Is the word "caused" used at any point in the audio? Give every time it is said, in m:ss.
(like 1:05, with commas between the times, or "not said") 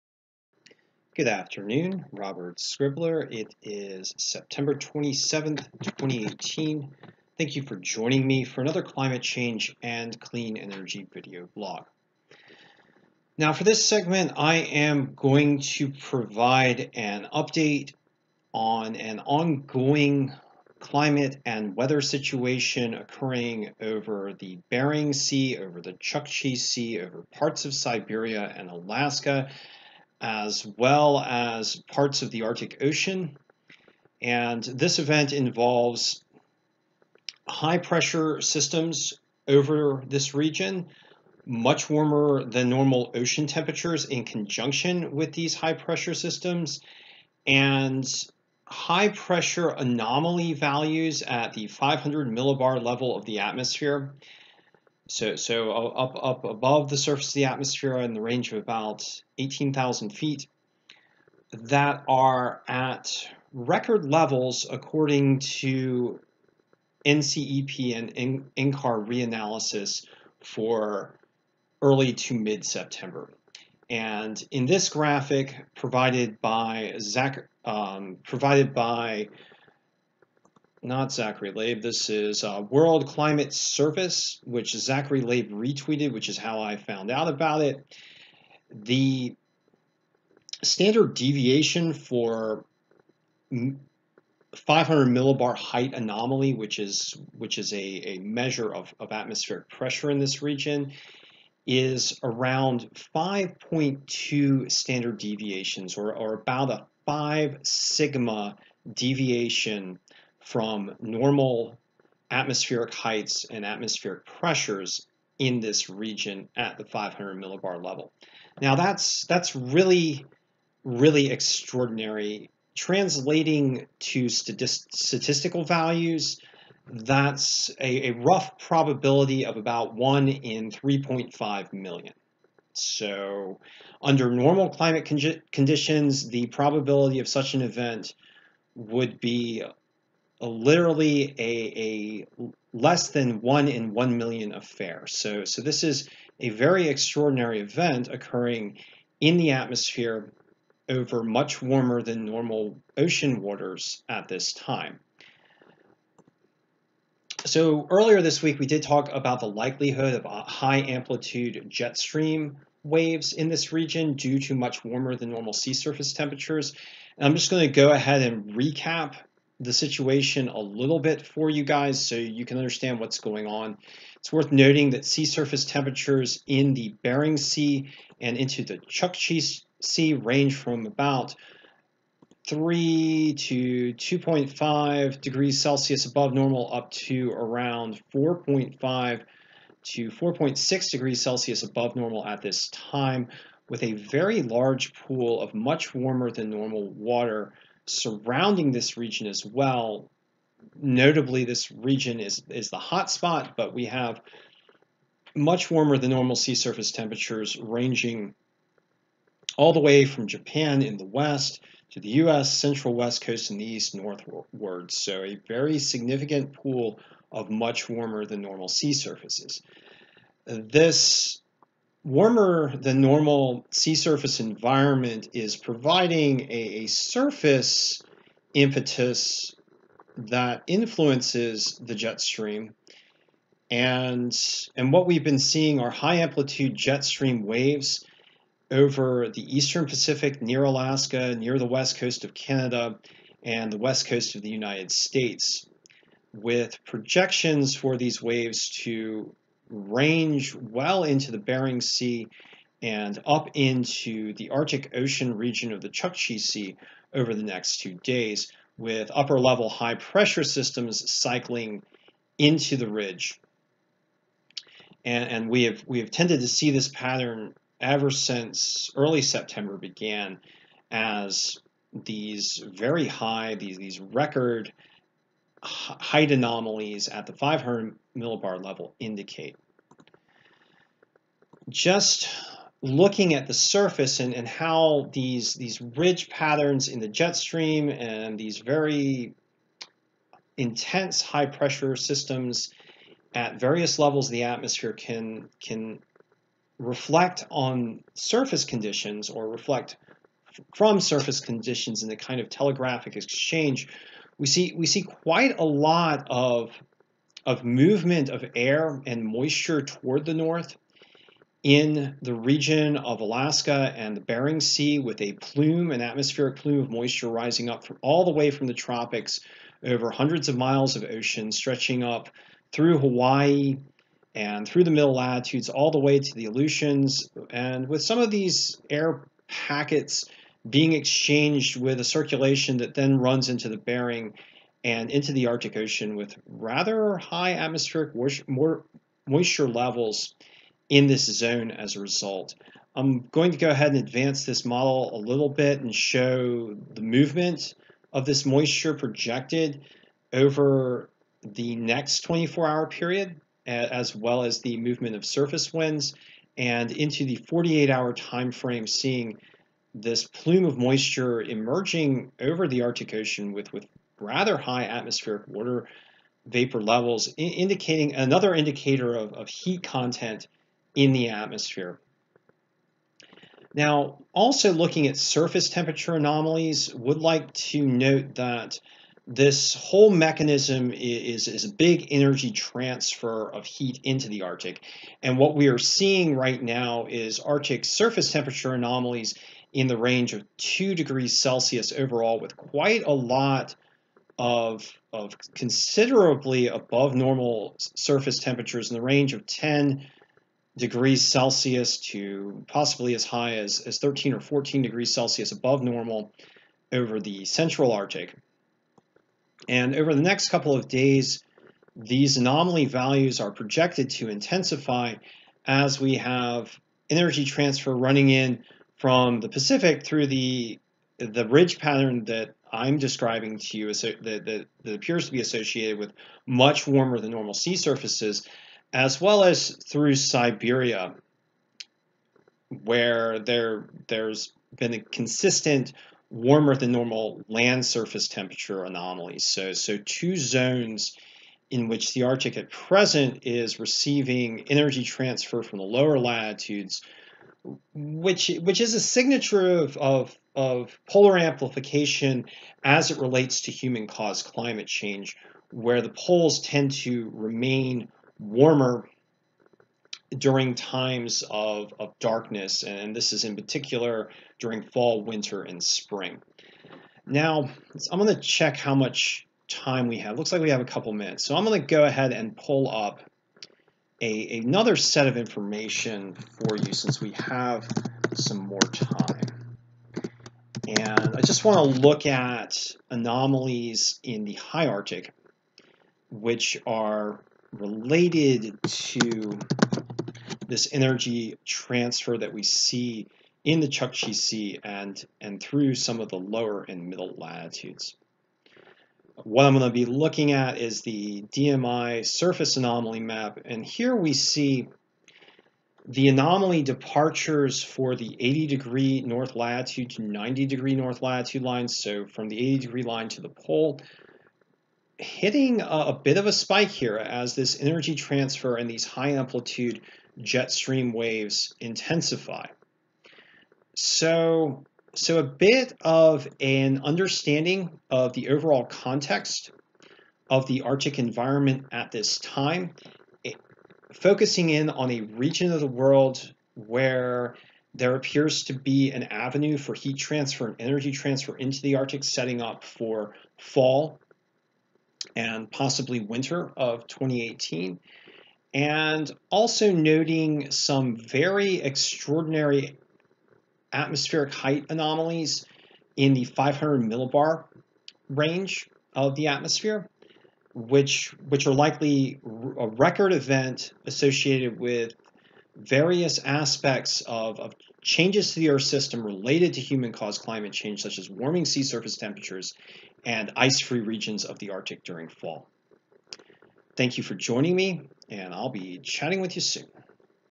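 7:34, 9:29.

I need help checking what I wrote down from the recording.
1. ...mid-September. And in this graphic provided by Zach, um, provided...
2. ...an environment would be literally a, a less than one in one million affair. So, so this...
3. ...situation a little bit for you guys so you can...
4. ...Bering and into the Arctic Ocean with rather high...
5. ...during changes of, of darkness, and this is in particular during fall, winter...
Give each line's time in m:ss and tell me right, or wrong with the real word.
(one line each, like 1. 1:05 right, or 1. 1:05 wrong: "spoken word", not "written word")
1. 1:12 right
2. 2:17 wrong: "event", not "environment"
3. 2:49 right
4. 5:33 right
5. 7:40 wrong: "times", not "changes".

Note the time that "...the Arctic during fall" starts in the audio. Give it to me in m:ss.
9:34.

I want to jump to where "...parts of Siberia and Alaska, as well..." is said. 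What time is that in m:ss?
0:27.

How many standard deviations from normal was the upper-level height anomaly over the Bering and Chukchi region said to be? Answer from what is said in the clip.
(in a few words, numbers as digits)
5.2.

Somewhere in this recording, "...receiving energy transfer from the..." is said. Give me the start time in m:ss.
7:23.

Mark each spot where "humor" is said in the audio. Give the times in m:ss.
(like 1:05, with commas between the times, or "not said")
not said.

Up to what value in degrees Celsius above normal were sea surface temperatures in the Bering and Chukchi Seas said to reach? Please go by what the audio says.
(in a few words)
4.6.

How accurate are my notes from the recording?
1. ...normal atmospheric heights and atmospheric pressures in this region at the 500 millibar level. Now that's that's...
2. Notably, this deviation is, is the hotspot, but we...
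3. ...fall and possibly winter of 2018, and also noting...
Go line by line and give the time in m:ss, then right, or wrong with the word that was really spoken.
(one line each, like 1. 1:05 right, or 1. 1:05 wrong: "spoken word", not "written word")
1. 1:50 right
2. 3:20 wrong: "region", not "deviation"
3. 9:03 right.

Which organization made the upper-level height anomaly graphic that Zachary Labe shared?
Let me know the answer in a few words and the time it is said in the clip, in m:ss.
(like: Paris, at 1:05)
World Climate Service, at 1:22.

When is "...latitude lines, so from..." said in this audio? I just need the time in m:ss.
8:31.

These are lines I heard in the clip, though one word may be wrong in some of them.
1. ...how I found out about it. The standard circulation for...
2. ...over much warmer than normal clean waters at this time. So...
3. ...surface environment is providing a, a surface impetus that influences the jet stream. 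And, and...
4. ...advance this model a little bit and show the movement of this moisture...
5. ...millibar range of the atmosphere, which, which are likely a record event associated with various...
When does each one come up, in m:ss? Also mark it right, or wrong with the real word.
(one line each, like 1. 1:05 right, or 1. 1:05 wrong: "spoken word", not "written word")
1. 1:26 wrong: "deviation", not "circulation"
2. 2:30 wrong: "ocean", not "clean"
3. 3:43 right
4. 5:43 right
5. 9:17 right.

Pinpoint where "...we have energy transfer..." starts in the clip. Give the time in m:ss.
6:55.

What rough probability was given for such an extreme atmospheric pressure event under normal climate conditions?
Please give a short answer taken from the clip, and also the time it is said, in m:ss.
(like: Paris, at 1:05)
1 in 3.5 million, at 2:09.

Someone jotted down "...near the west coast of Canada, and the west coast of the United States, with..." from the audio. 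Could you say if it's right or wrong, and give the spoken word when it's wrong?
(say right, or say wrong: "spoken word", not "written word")
right.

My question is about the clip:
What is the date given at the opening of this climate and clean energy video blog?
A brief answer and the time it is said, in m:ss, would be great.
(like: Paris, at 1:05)
September 27th, 2018, at 0:04.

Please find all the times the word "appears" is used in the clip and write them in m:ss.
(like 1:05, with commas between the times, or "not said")
7:04, 8:58.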